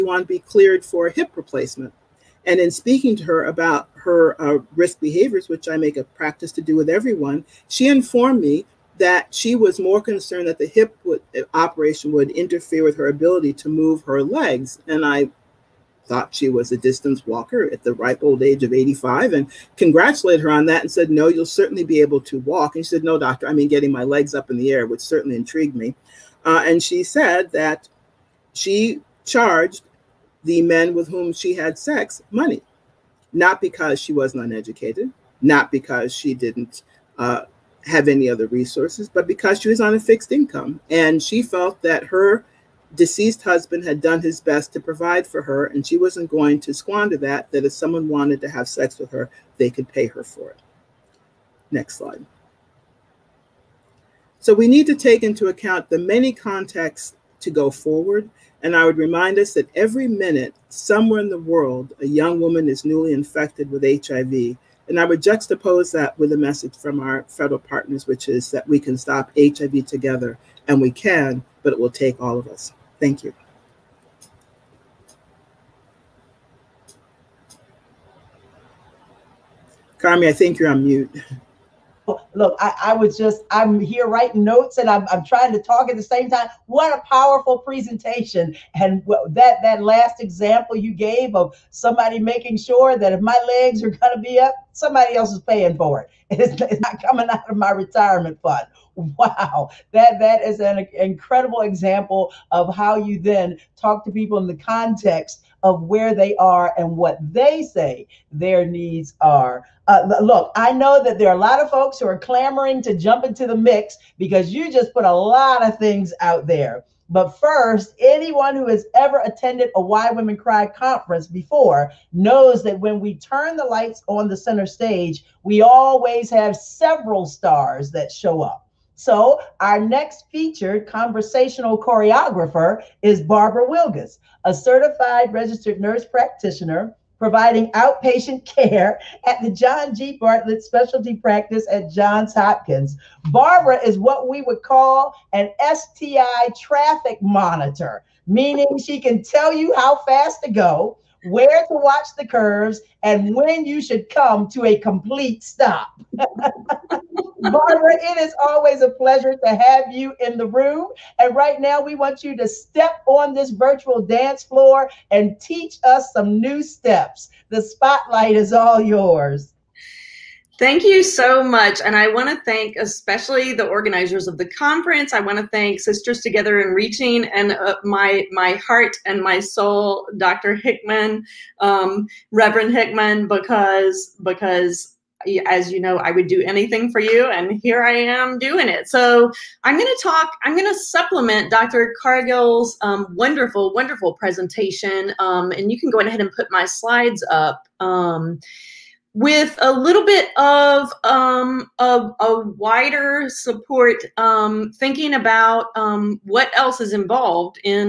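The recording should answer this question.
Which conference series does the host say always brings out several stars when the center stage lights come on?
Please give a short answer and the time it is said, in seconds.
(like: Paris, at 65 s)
Why Women Cry, at 119 s.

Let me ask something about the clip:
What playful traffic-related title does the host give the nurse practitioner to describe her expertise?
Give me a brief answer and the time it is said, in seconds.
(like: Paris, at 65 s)
STI traffic monitor, at 145 s.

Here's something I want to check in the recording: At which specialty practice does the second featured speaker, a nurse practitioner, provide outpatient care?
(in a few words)
John G. Bartlett Specialty Practice.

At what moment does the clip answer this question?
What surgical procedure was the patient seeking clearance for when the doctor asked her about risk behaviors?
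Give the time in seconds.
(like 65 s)
1 s.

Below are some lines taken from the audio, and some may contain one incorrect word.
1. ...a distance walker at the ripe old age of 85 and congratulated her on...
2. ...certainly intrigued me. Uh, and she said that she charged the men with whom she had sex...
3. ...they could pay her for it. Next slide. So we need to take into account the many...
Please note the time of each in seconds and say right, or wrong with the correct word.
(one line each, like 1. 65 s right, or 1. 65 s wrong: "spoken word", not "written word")
1. 16 s right
2. 24 s right
3. 49 s right.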